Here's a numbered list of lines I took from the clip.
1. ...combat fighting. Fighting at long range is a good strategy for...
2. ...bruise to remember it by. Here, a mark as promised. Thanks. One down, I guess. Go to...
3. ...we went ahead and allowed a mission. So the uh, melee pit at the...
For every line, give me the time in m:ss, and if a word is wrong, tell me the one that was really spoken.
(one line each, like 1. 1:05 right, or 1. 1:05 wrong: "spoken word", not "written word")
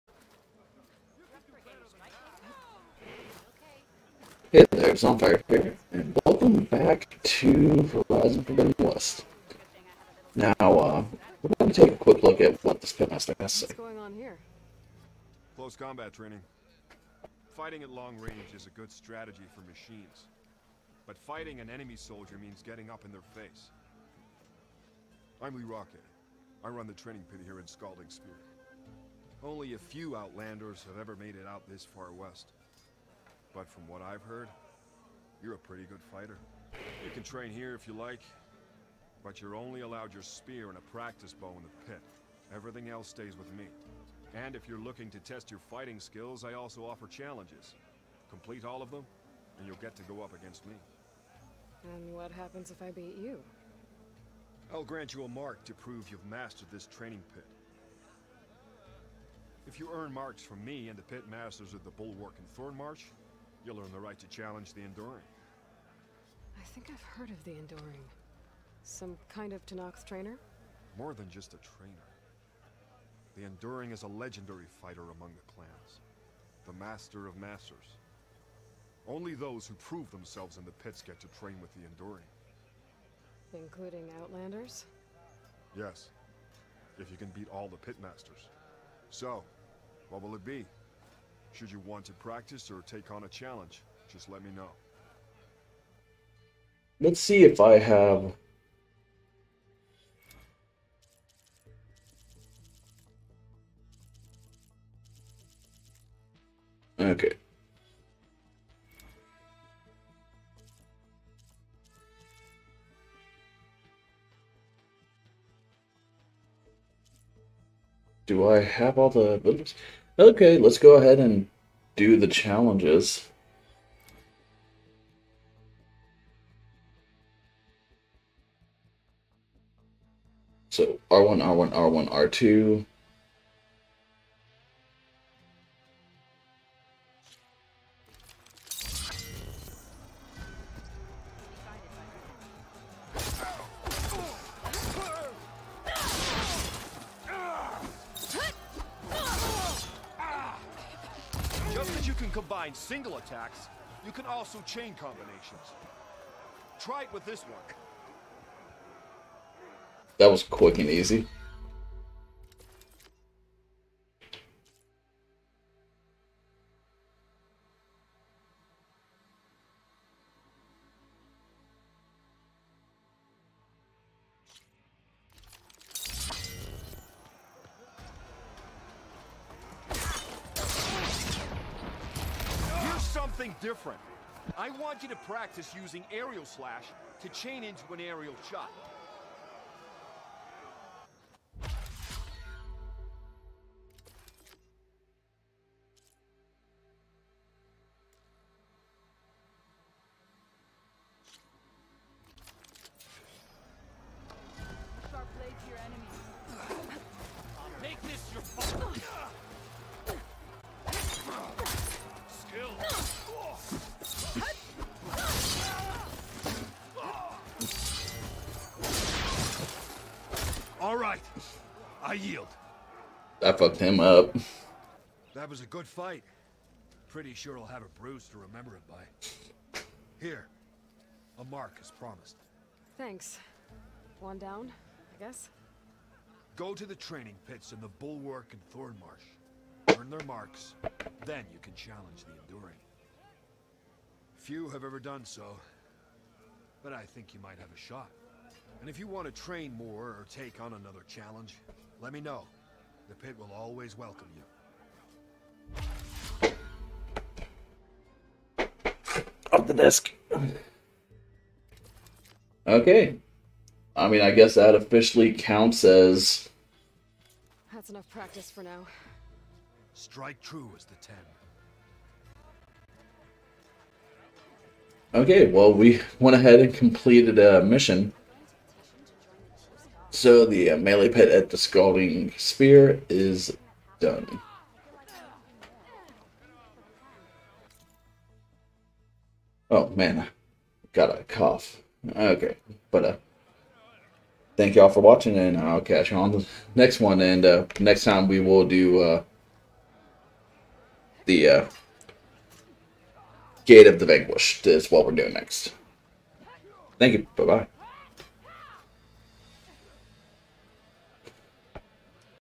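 1. 0:15 wrong: "training", not "fighting"
2. 3:47 right
3. 4:35 wrong: "completed", not "allowed".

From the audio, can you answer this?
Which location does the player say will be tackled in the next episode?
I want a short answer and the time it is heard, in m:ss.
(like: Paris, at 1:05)
Gate of the Vanquished, at 5:03.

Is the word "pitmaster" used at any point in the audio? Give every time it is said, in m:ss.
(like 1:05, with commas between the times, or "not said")
0:12, 1:27.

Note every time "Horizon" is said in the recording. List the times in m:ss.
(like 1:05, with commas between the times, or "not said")
0:08.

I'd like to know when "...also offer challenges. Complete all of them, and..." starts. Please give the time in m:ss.
0:46.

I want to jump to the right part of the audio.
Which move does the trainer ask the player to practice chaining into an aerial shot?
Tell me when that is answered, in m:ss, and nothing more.
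3:06.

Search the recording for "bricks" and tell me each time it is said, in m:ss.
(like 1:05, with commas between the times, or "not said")
not said.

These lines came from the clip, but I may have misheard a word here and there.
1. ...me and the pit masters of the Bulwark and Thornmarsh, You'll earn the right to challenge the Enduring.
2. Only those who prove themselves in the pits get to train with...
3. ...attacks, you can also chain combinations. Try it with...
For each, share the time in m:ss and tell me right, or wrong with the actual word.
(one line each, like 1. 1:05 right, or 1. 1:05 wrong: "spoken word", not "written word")
1. 1:00 right
2. 1:19 right
3. 2:33 right.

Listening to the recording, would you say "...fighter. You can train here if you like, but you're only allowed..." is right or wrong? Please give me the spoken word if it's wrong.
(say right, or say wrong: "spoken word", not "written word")
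right.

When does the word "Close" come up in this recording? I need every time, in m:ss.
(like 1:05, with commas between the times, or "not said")
0:15.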